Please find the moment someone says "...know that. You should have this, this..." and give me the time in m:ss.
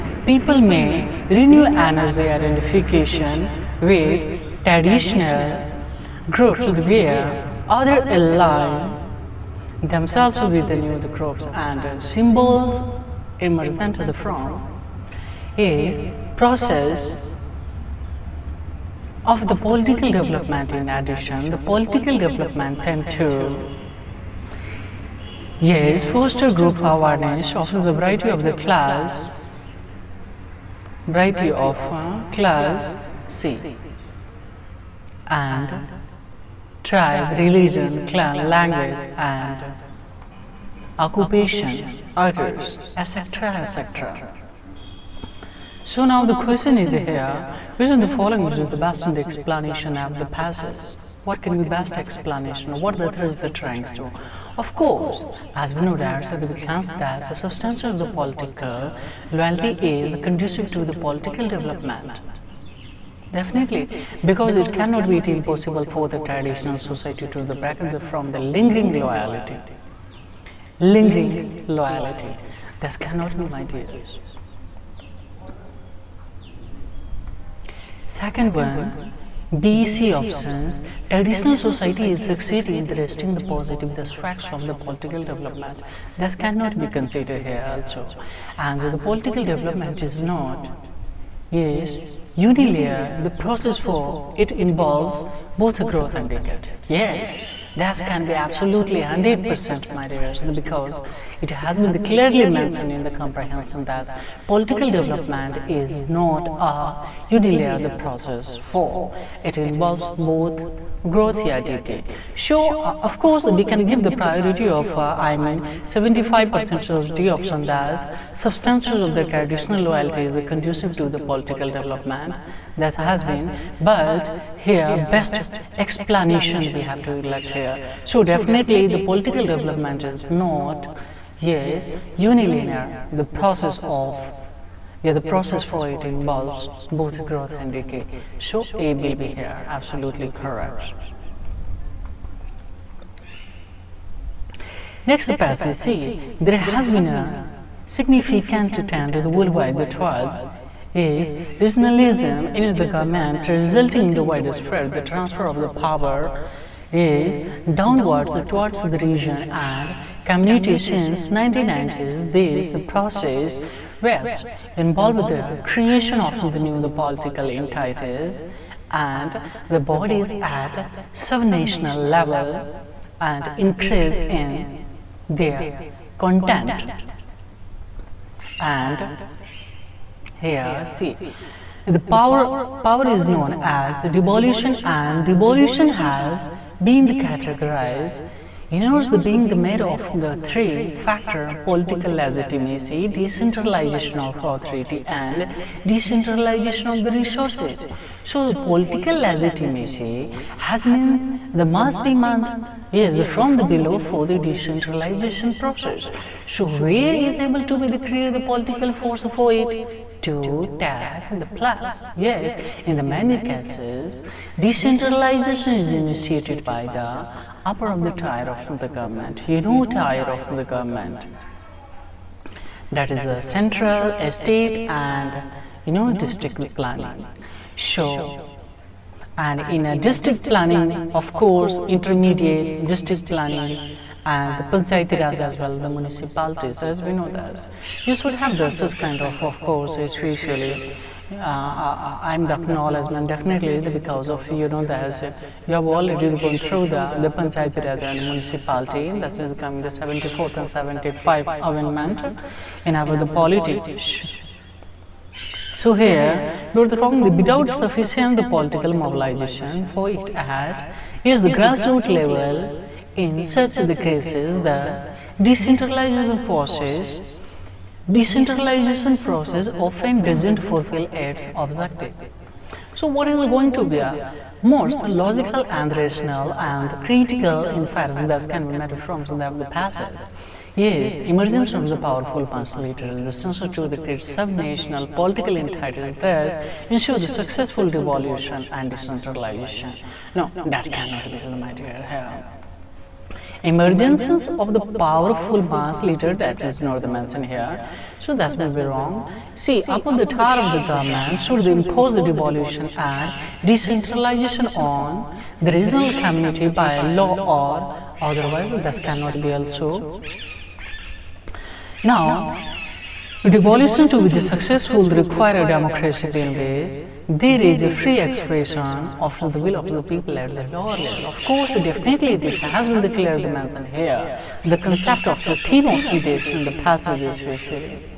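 3:57.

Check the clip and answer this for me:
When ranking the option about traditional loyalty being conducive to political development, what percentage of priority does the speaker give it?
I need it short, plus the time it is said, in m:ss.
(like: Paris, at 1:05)
75%, at 1:55.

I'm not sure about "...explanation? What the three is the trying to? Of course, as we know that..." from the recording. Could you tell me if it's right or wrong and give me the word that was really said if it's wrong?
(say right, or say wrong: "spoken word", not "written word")
right.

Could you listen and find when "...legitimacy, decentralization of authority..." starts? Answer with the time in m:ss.
3:12.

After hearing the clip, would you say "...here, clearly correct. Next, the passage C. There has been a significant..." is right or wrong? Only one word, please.
wrong.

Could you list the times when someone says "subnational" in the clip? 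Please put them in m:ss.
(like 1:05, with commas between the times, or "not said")
2:51, 4:44.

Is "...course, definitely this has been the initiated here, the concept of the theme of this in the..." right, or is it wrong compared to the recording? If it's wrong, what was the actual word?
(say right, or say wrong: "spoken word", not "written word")
wrong: "mentioned", not "initiated".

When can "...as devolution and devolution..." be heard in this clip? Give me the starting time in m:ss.
3:03.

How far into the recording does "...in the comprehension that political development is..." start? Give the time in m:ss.
1:42.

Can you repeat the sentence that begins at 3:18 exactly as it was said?
So the political legitimacy has means the mass demand is yes, from the below for the decentralization process.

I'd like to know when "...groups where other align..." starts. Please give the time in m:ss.
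0:06.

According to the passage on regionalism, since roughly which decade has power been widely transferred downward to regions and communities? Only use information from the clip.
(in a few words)
1990s.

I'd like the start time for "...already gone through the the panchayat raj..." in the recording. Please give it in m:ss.
4:05.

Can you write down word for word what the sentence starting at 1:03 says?
Definitely, because it cannot be impossible for the traditional society to the from the lingering loyalty.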